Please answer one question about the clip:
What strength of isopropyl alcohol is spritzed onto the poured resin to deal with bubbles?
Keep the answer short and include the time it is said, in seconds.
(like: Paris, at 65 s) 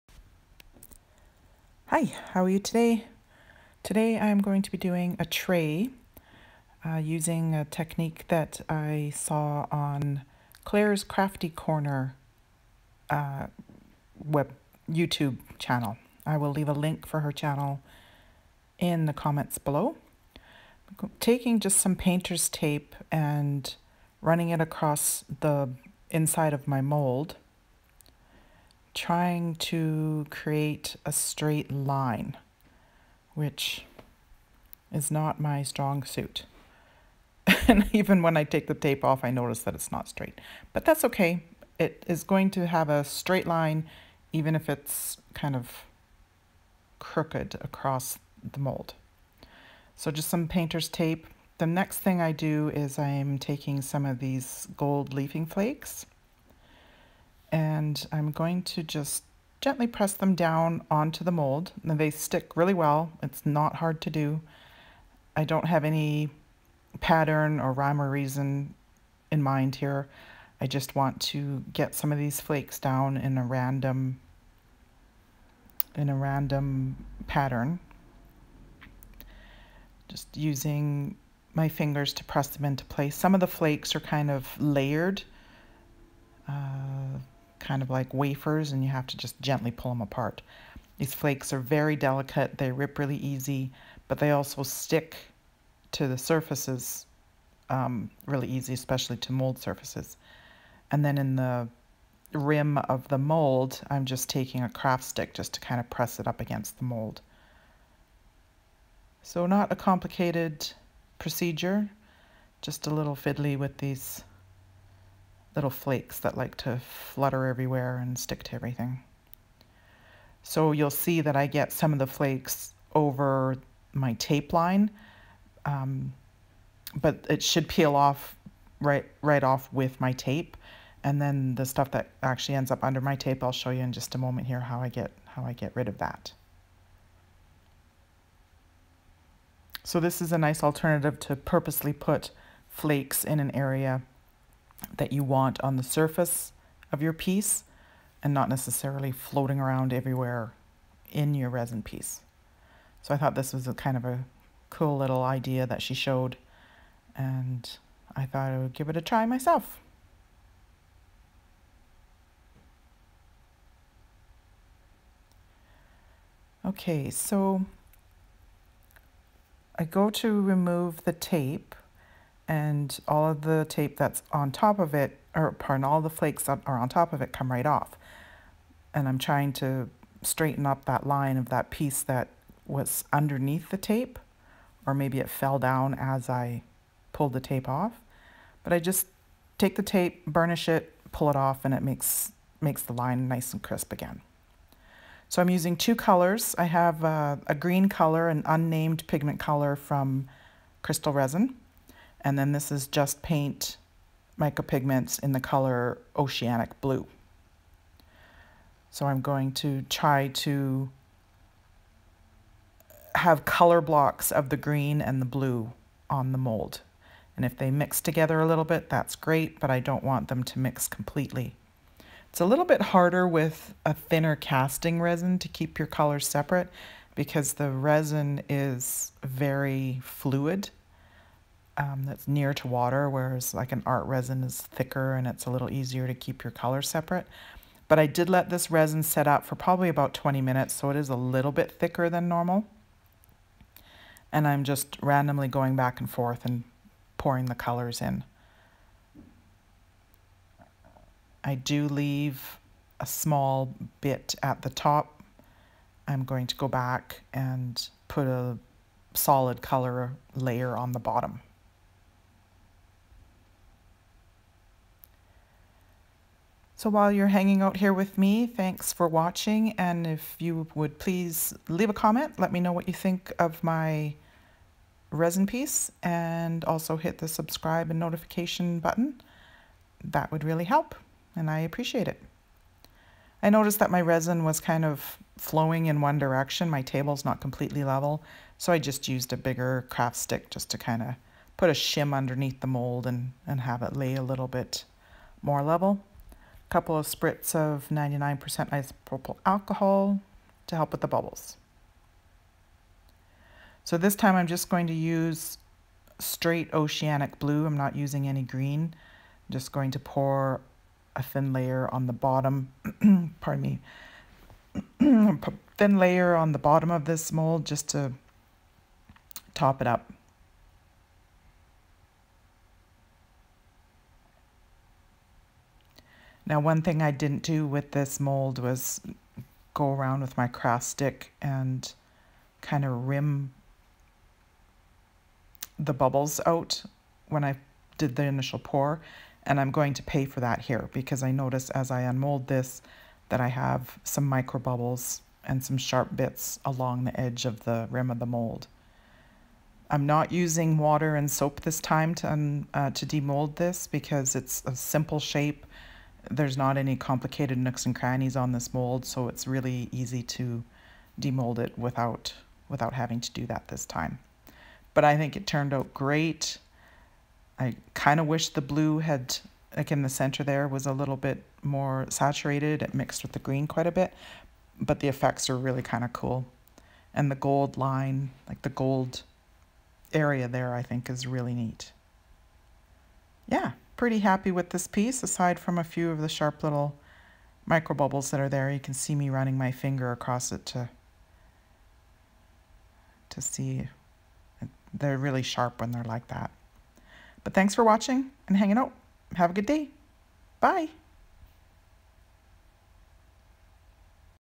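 99%, at 297 s.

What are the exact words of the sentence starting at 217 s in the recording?
And if they mix together a little bit, that's great, but I don't want them to mix completely.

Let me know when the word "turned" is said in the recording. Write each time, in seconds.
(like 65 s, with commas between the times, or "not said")
365 s.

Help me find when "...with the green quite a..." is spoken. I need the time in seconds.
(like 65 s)
373 s.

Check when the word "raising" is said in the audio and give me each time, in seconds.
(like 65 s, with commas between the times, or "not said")
not said.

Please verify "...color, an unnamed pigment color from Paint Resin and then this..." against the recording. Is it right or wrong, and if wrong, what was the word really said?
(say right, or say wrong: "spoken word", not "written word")
wrong: "Krystal", not "Paint".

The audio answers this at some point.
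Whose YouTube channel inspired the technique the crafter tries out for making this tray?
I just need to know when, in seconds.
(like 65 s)
10 s.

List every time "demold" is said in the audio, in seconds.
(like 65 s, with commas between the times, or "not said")
353 s, 361 s.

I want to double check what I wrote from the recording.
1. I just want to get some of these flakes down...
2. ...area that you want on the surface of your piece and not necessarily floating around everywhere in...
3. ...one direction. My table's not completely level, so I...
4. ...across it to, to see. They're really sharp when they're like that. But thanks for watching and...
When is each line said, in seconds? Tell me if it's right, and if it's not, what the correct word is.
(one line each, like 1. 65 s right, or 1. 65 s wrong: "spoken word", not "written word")
1. 70 s right
2. 143 s right
3. 286 s right
4. 390 s right.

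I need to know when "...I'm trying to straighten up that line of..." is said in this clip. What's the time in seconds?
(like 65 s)
179 s.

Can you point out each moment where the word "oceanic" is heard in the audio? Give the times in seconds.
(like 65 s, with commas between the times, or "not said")
206 s, 306 s.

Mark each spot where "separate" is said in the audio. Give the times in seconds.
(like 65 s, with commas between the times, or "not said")
226 s, 236 s.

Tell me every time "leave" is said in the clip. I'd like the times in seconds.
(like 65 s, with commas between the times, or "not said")
16 s, 251 s, 271 s.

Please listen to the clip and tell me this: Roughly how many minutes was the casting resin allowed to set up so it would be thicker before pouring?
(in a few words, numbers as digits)
20 minutes.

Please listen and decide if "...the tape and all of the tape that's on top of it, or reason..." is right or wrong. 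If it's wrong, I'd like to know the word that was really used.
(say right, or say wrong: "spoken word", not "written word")
wrong: "pardon", not "reason".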